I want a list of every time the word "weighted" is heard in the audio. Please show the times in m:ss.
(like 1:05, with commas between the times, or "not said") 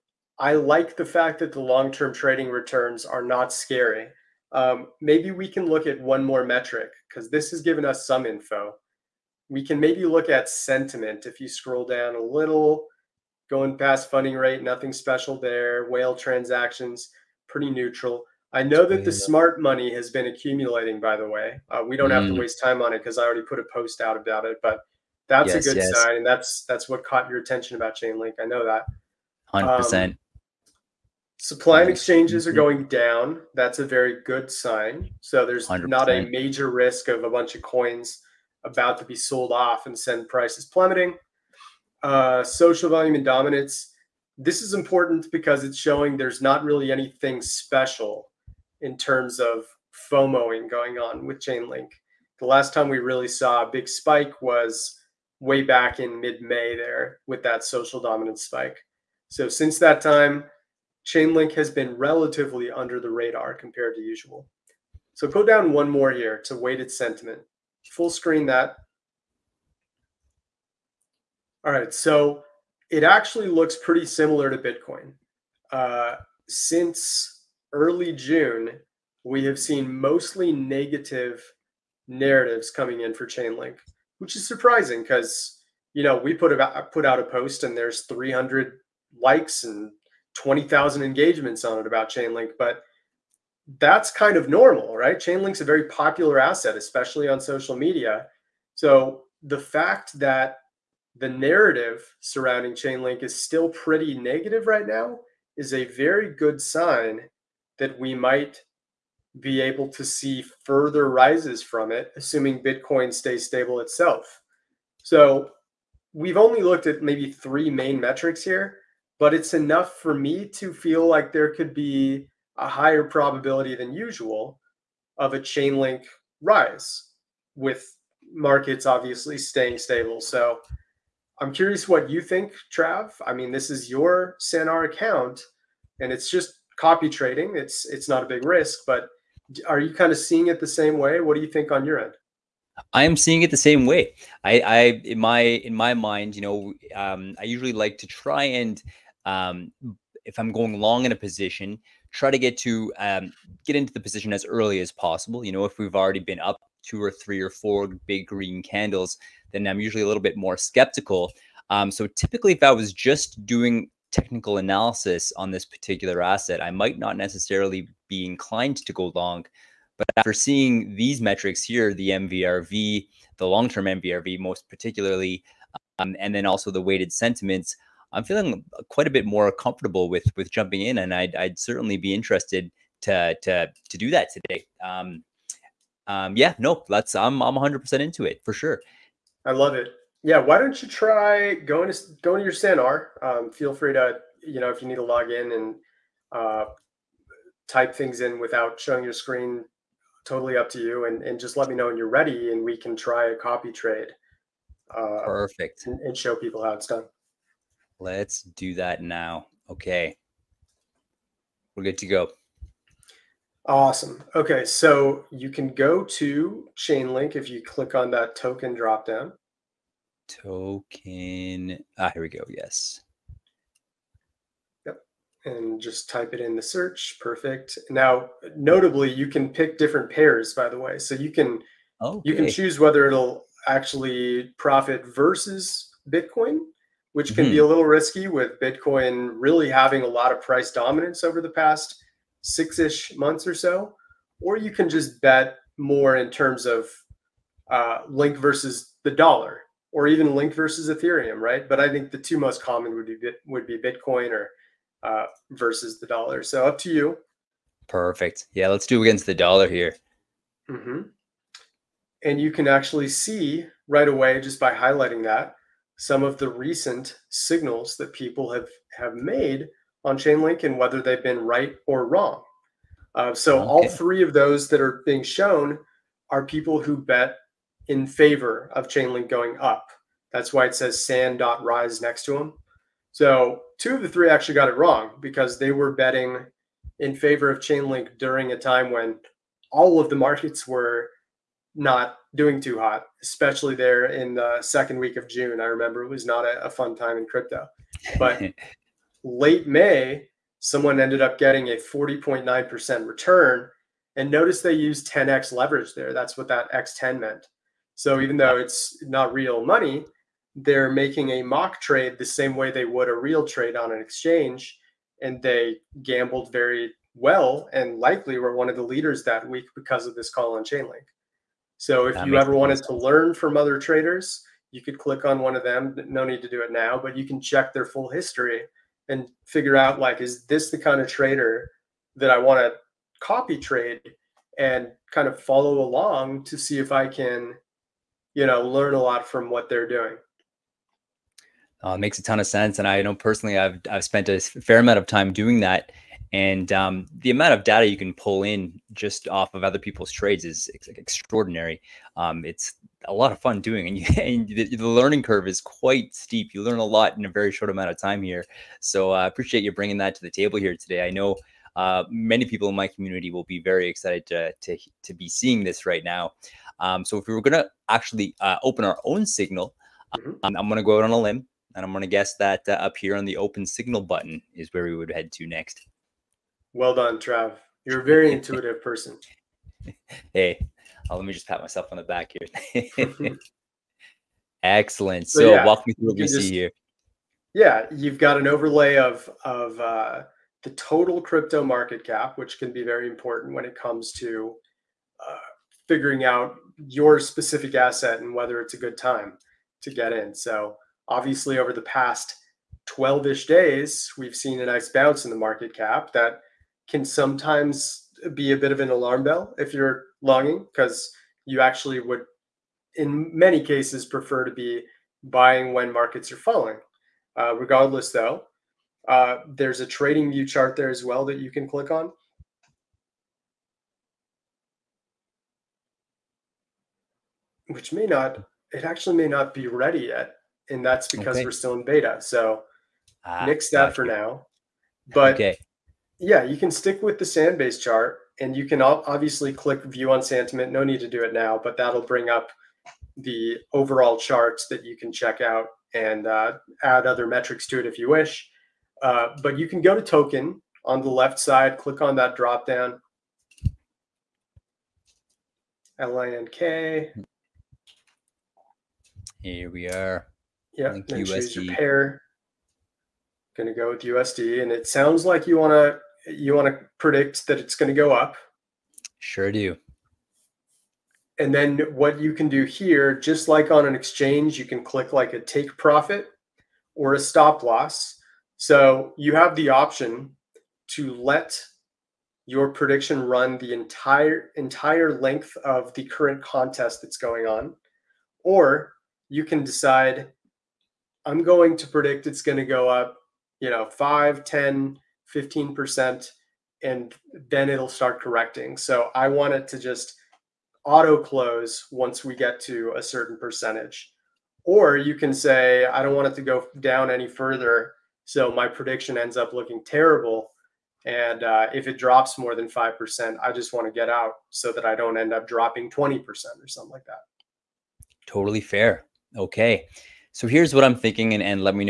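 1:06, 2:56.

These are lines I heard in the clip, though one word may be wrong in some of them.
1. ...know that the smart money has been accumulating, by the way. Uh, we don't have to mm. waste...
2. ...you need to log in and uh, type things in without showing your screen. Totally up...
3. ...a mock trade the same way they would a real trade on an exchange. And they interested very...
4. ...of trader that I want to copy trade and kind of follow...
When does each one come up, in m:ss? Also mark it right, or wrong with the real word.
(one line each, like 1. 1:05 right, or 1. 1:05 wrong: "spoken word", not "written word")
1. 0:18 right
2. 3:14 right
3. 5:11 wrong: "gambled", not "interested"
4. 5:30 right.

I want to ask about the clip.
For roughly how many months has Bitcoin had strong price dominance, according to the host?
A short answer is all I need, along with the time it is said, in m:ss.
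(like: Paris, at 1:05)
6, at 4:02.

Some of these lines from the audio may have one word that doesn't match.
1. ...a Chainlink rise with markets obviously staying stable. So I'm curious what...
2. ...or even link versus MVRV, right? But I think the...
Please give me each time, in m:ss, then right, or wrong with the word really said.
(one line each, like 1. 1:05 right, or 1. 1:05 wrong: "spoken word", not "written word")
1. 2:05 right
2. 4:09 wrong: "Ethereum", not "MVRV".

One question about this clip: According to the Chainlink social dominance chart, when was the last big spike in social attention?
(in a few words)
mid May.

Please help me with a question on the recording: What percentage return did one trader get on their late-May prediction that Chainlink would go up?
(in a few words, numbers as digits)
40.9%.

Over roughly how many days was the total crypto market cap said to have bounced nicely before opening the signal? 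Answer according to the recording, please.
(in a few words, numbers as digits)
12.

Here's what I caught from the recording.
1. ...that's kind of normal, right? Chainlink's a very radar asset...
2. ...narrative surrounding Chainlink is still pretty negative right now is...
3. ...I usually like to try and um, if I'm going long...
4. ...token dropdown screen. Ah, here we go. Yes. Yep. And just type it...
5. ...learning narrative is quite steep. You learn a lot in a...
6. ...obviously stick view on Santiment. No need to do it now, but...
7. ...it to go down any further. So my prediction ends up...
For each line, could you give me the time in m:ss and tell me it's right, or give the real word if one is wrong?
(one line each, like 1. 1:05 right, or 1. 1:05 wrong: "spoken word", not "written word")
1. 1:33 wrong: "popular", not "radar"
2. 1:41 right
3. 2:27 right
4. 3:38 wrong: "token", not "screen"
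5. 5:54 wrong: "curve", not "narrative"
6. 7:18 wrong: "click", not "stick"
7. 8:26 right.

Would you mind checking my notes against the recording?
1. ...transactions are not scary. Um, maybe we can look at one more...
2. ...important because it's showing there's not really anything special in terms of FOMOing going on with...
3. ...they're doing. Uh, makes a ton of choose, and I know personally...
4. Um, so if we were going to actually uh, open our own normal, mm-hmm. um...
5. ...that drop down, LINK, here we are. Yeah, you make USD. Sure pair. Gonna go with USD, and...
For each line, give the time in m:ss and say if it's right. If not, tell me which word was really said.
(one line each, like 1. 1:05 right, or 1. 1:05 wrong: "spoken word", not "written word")
1. 0:02 wrong: "returns", not "transactions"
2. 0:44 right
3. 5:39 wrong: "sense", not "choose"
4. 6:06 wrong: "signal", not "normal"
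5. 7:32 right.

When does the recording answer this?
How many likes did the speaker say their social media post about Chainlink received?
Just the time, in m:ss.
1:28.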